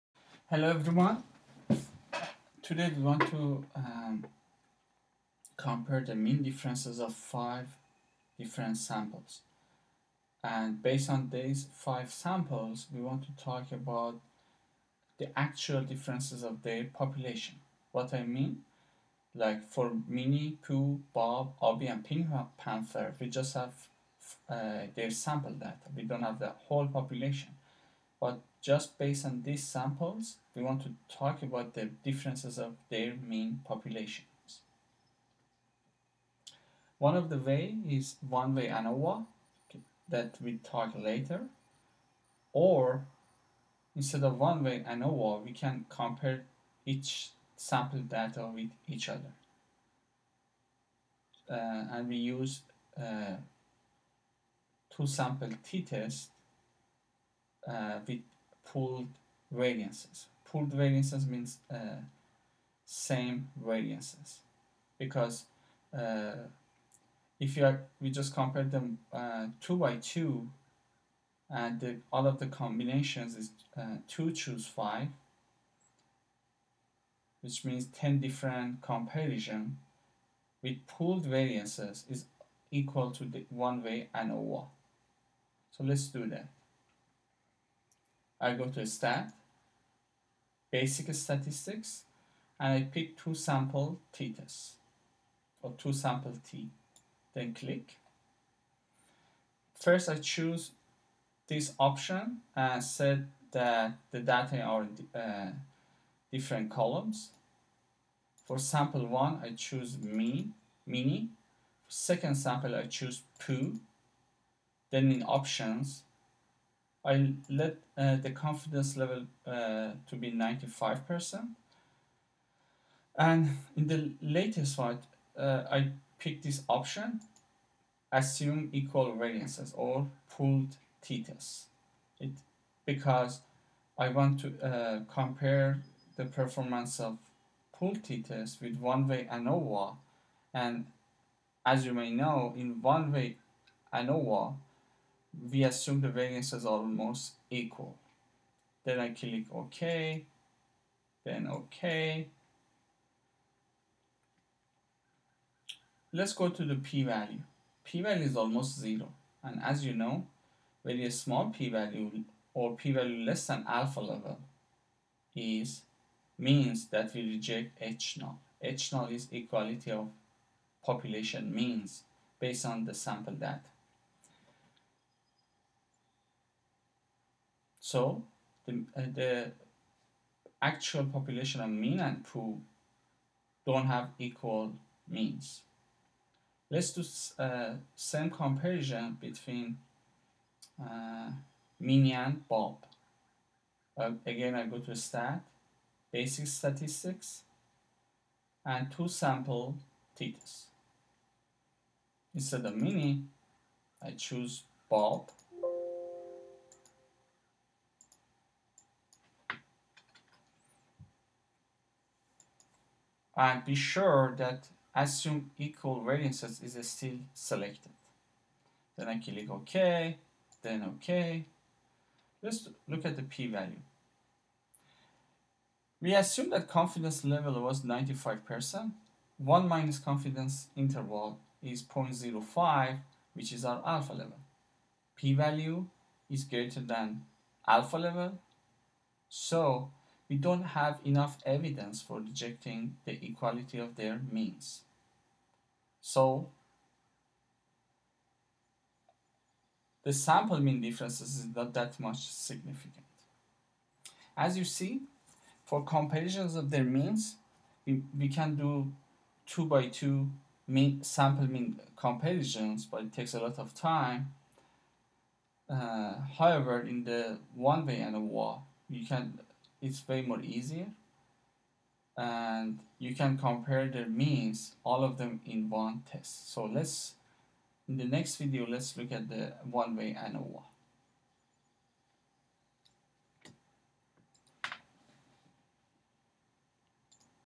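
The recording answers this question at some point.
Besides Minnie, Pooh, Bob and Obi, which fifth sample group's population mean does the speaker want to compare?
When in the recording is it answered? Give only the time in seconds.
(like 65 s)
22 s.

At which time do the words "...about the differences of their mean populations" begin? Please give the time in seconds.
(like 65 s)
31 s.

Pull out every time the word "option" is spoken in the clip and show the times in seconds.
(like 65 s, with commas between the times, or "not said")
101 s, 115 s, 126 s.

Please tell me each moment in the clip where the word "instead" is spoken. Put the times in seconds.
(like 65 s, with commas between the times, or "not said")
43 s, 202 s.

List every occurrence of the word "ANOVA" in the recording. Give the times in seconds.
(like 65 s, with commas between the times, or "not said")
38 s, 44 s, 84 s, 139 s, 143 s, 267 s, 280 s.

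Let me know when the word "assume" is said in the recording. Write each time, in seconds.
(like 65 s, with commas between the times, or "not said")
128 s, 145 s, 214 s, 226 s.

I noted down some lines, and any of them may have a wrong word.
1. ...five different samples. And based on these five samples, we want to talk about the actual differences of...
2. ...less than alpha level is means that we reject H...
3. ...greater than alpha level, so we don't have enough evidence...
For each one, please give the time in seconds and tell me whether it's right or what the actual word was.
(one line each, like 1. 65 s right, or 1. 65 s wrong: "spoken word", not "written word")
1. 7 s right
2. 163 s right
3. 236 s right.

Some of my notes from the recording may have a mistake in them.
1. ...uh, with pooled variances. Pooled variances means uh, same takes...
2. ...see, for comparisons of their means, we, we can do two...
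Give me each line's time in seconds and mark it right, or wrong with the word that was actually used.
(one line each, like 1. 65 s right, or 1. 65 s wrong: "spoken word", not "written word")
1. 57 s wrong: "variances", not "takes"
2. 254 s right.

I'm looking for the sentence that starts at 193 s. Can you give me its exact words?
Uh, again, I go to stat, basic statistics, and two sample T-Test.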